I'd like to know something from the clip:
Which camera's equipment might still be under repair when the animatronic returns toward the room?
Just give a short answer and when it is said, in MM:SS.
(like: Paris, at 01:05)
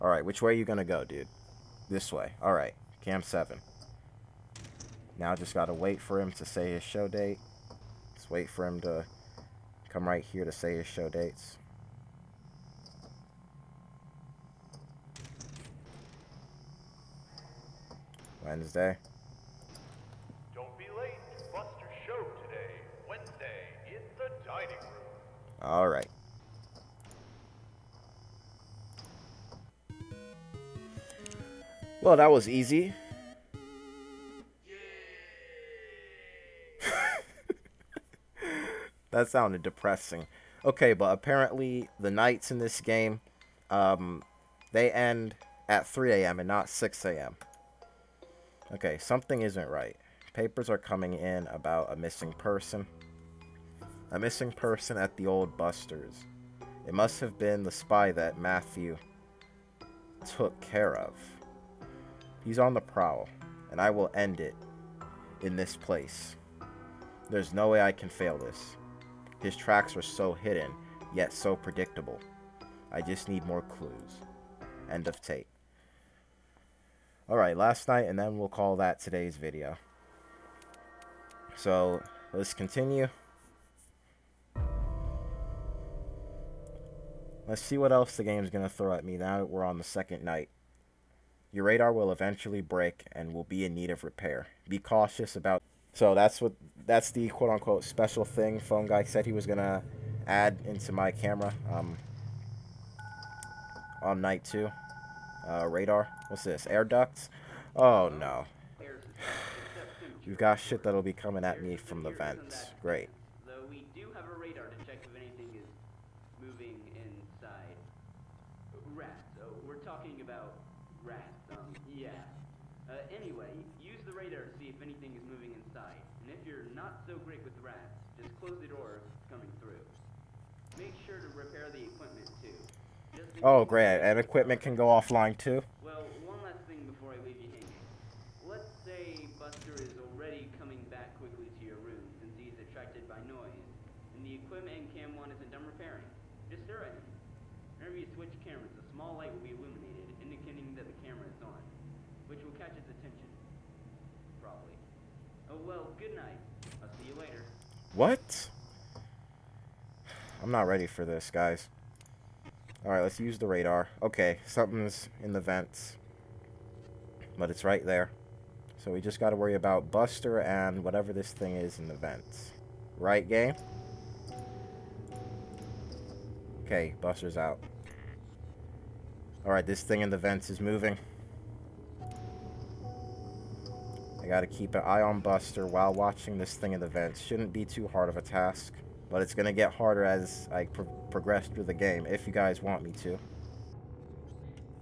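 Cam 1, at 02:24.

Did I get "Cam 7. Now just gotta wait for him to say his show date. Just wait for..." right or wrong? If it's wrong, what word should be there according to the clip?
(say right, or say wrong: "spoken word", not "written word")
right.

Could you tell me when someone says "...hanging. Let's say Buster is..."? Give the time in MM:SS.
02:17.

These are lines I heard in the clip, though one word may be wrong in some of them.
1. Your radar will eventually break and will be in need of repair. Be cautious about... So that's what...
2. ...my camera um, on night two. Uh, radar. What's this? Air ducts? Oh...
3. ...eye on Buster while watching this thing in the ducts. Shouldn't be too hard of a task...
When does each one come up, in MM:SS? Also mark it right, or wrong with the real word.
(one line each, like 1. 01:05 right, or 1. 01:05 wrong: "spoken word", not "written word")
1. 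01:31 right
2. 01:40 right
3. 03:04 wrong: "vents", not "ducts".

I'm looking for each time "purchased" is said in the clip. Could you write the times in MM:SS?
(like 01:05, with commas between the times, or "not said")
not said.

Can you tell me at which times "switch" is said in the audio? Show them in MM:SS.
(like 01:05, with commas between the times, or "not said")
02:28.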